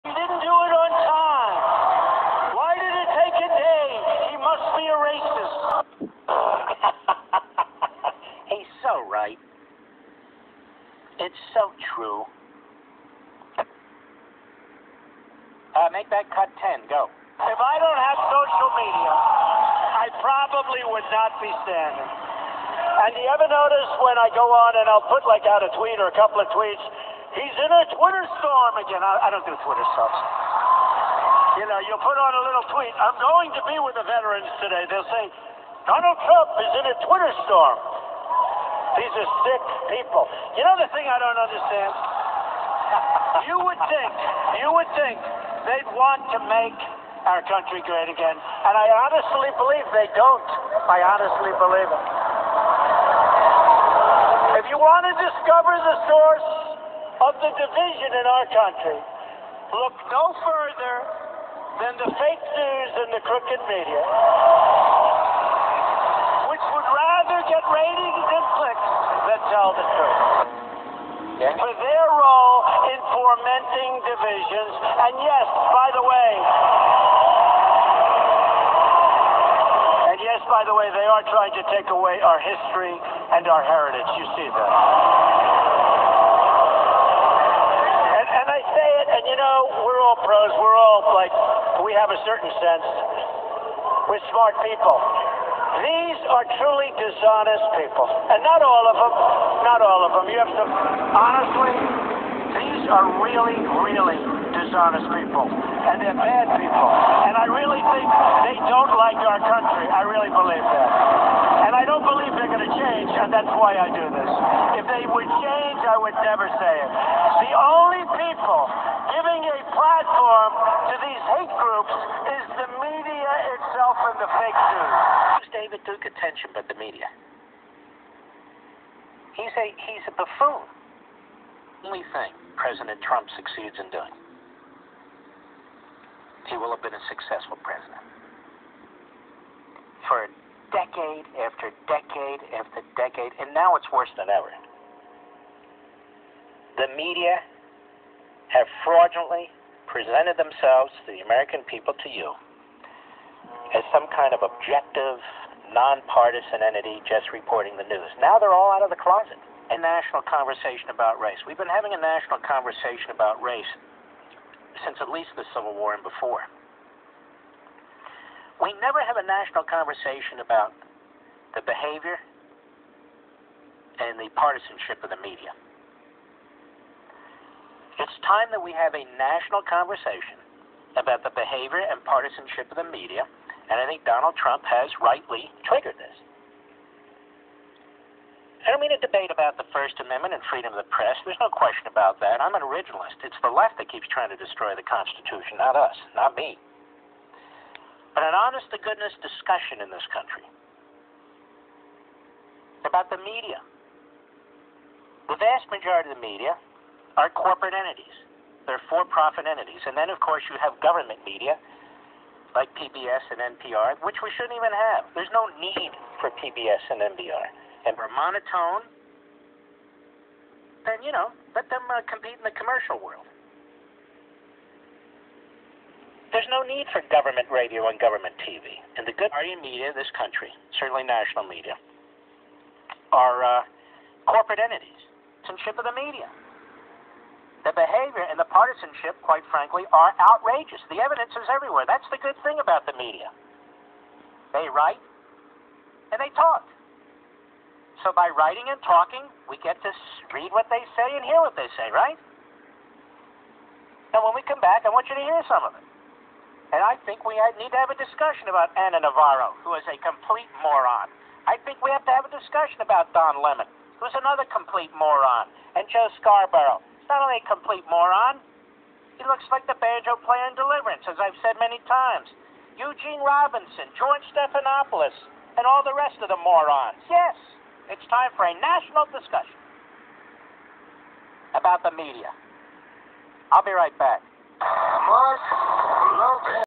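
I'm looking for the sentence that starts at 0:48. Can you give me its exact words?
And I honestly believe they don't.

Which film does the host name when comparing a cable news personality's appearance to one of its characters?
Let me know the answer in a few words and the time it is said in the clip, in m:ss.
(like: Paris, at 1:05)
Deliverance, at 4:30.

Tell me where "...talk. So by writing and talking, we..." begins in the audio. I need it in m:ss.
4:06.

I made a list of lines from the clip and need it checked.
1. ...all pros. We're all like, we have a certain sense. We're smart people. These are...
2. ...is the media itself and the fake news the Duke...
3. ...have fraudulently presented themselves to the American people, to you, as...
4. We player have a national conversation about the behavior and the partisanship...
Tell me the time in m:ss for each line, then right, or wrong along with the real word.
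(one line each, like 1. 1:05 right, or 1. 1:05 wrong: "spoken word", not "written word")
1. 1:30 right
2. 2:02 right
3. 2:28 right
4. 2:48 wrong: "never", not "player".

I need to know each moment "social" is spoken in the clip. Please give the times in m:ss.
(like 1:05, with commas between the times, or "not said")
0:18.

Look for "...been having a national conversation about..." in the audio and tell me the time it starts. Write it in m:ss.
2:41.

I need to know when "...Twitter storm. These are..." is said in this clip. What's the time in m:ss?
0:37.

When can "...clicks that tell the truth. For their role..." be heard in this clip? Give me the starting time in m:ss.
1:08.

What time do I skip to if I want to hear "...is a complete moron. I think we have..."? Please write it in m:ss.
4:19.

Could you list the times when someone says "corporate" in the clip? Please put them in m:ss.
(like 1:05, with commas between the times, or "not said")
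3:27, 3:54.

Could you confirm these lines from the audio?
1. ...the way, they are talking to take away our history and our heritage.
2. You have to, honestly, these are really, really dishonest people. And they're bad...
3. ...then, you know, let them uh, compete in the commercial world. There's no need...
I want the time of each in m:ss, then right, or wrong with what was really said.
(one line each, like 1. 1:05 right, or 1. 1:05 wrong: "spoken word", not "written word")
1. 1:20 wrong: "trying", not "talking"
2. 1:40 right
3. 3:40 right.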